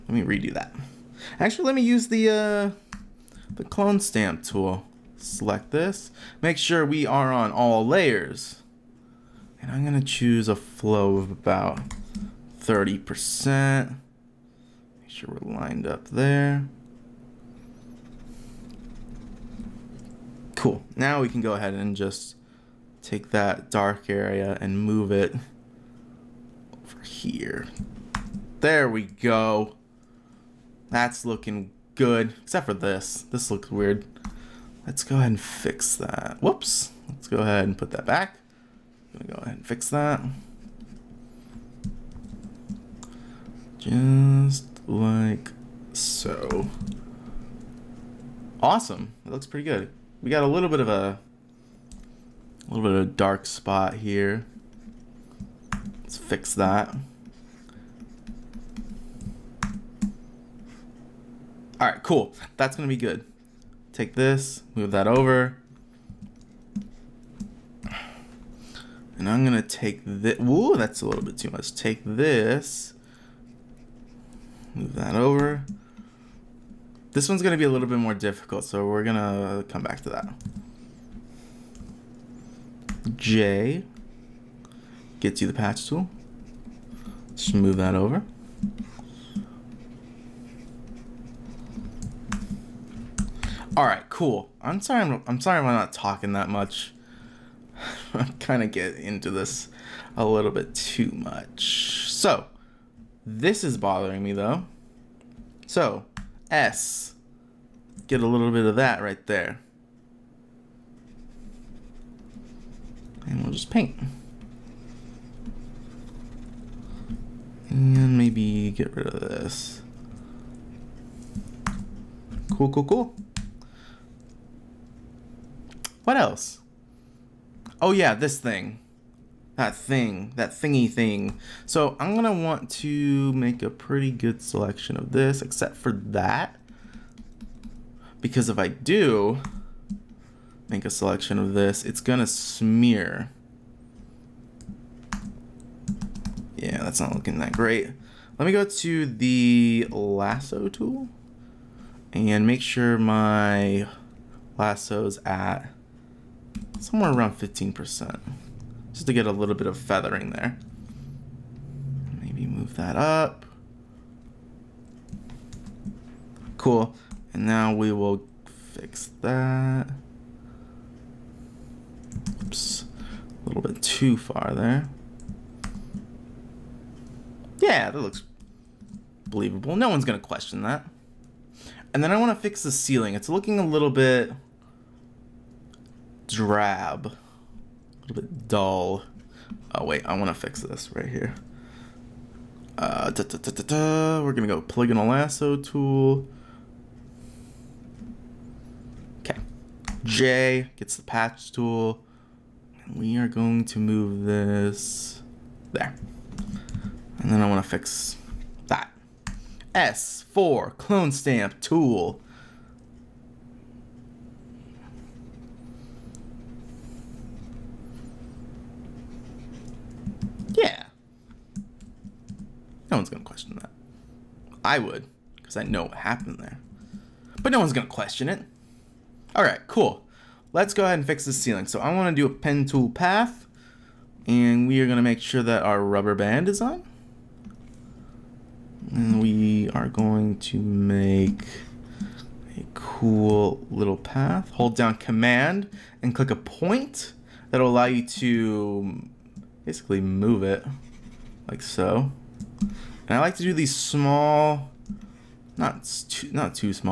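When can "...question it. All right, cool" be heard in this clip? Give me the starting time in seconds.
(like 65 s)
227 s.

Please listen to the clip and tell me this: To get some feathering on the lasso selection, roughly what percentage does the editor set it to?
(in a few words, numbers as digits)
15%.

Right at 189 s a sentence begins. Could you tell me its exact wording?
Oh wait, I want to fix this right here.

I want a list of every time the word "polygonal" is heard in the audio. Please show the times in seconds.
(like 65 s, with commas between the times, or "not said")
194 s.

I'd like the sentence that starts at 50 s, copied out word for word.
We got a little bit of a, a little bit of a dark spot here.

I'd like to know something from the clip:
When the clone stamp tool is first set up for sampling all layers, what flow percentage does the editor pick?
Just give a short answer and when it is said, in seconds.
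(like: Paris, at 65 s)
30%, at 12 s.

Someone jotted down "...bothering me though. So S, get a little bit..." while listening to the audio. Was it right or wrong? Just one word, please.
right.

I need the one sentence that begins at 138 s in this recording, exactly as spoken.
Because if I do make a selection of this, it's gonna smear.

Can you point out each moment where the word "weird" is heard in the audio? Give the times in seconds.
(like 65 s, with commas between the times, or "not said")
33 s.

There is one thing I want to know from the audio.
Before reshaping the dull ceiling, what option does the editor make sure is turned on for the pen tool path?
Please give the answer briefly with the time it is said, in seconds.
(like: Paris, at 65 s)
rubber band, at 235 s.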